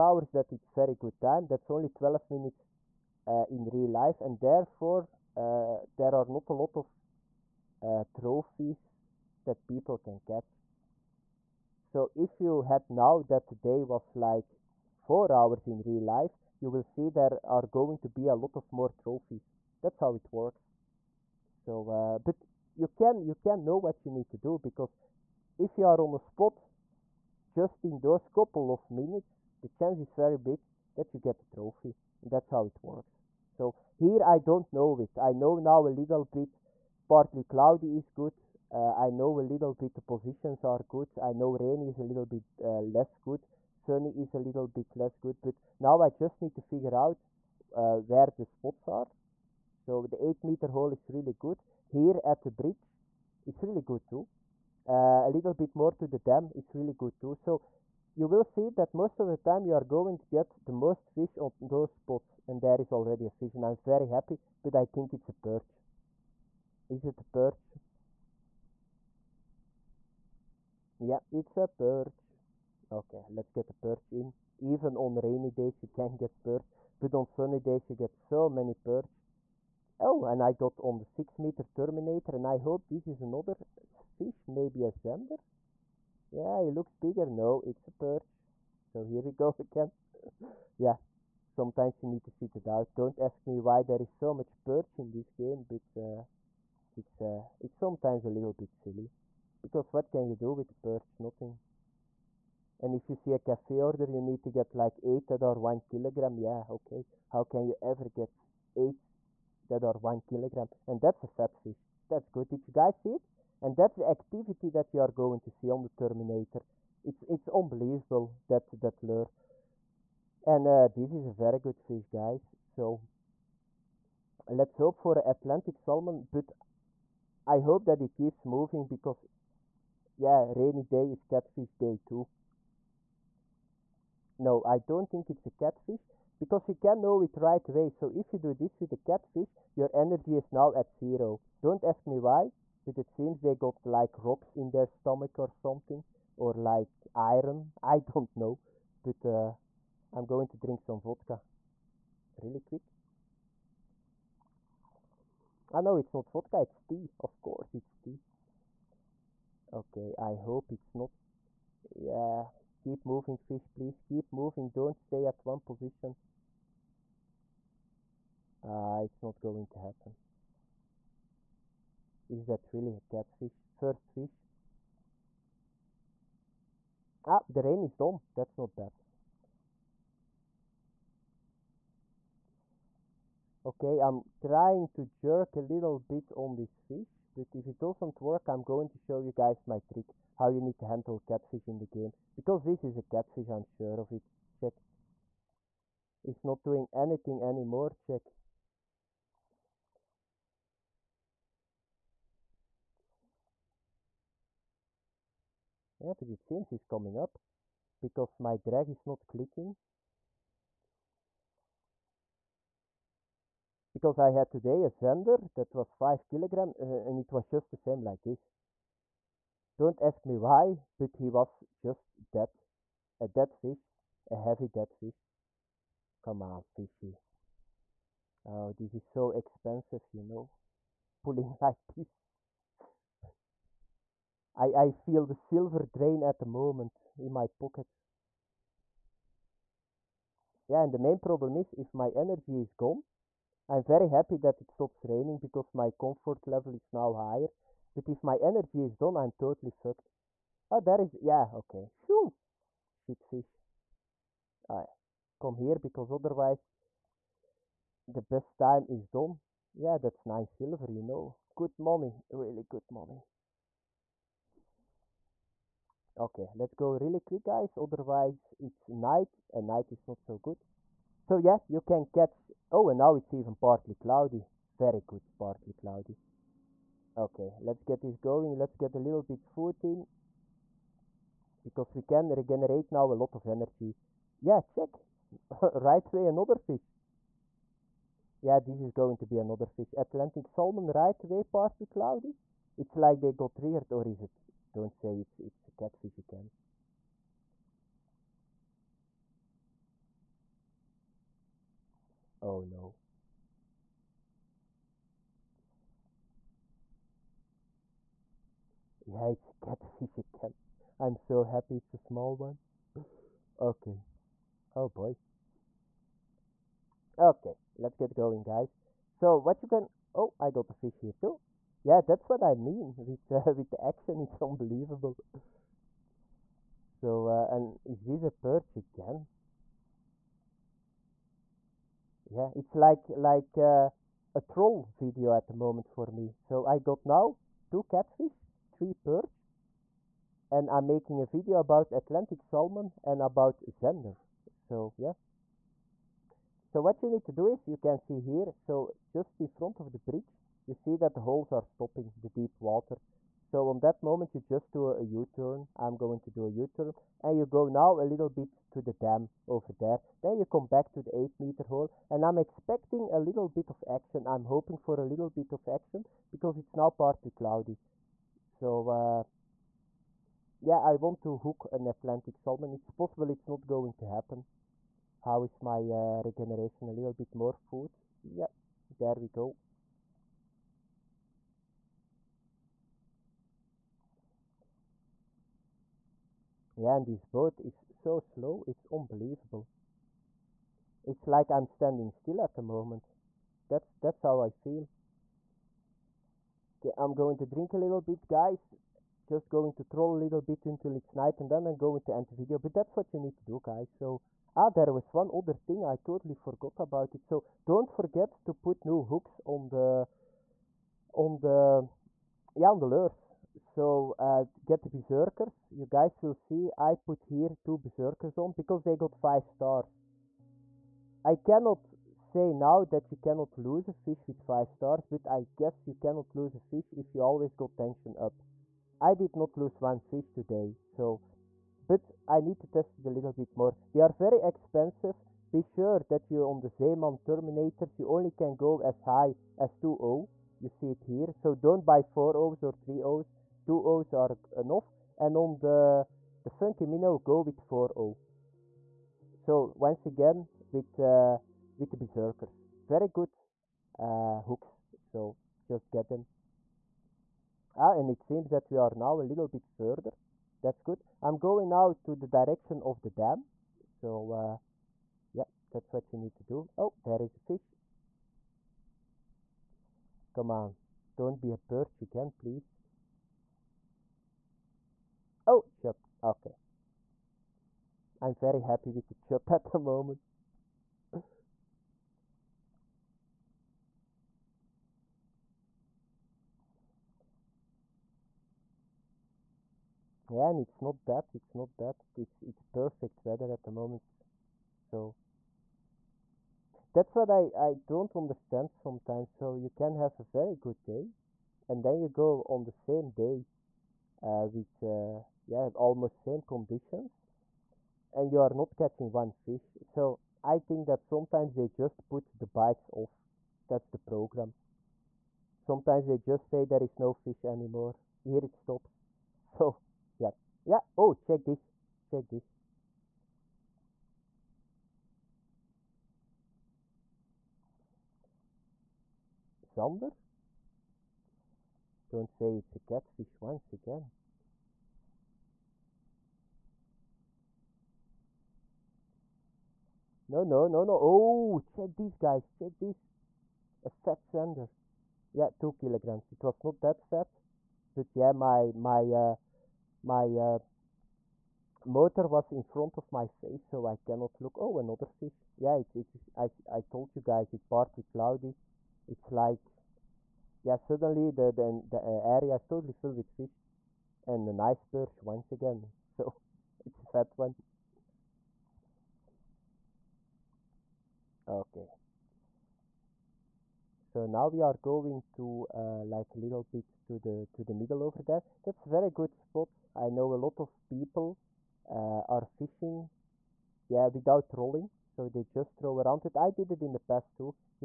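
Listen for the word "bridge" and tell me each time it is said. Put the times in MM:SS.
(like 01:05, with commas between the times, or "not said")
00:52, 05:49.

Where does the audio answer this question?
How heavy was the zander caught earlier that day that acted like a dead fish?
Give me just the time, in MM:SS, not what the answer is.
03:35.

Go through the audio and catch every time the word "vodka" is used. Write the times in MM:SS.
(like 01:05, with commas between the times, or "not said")
02:31, 02:36.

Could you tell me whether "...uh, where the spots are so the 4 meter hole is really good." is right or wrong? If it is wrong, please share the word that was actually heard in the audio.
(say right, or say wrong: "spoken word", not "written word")
wrong: "8", not "4".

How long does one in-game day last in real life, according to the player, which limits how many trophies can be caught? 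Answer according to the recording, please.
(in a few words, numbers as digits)
12 minutes.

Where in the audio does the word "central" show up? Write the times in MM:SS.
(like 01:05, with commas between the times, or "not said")
not said.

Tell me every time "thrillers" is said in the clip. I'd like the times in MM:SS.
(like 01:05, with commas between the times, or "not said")
not said.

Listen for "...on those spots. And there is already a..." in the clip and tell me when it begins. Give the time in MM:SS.
01:01.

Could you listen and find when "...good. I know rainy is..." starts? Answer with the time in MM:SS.
00:40.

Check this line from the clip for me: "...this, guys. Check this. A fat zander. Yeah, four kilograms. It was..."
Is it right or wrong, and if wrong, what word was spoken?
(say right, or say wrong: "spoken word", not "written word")
wrong: "two", not "four".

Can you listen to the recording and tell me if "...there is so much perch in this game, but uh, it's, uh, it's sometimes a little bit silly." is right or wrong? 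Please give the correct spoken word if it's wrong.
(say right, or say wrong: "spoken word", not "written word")
right.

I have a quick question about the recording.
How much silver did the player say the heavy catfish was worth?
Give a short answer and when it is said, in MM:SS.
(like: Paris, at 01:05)
9 silver, at 04:20.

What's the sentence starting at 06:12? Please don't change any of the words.
It's possible it's not going to happen.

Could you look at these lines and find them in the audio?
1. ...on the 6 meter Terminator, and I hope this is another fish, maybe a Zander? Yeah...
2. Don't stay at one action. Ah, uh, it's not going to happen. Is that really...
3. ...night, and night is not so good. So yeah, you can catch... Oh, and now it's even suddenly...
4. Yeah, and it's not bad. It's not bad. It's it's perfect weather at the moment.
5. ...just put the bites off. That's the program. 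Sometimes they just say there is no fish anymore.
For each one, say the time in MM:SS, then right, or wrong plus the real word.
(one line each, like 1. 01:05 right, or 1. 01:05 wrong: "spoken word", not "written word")
1. 01:20 right
2. 02:44 wrong: "position", not "action"
3. 04:28 wrong: "partly", not "suddenly"
4. 08:10 right
5. 08:31 right.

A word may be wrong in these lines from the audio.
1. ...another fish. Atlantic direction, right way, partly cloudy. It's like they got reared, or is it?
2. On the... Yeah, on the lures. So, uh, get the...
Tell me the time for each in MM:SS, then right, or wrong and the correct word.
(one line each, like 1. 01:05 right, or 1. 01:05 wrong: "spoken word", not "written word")
1. 04:49 wrong: "salmon", not "direction"
2. 06:51 right.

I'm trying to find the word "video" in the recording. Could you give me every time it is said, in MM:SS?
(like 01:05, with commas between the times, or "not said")
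05:34, 05:41, 06:42.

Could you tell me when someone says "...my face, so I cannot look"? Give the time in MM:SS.
09:13.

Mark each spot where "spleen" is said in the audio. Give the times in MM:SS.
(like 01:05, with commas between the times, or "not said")
not said.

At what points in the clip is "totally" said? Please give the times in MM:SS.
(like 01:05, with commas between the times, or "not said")
04:09, 06:45, 09:22.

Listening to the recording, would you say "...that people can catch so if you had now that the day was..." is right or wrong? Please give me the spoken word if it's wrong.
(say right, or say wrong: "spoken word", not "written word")
right.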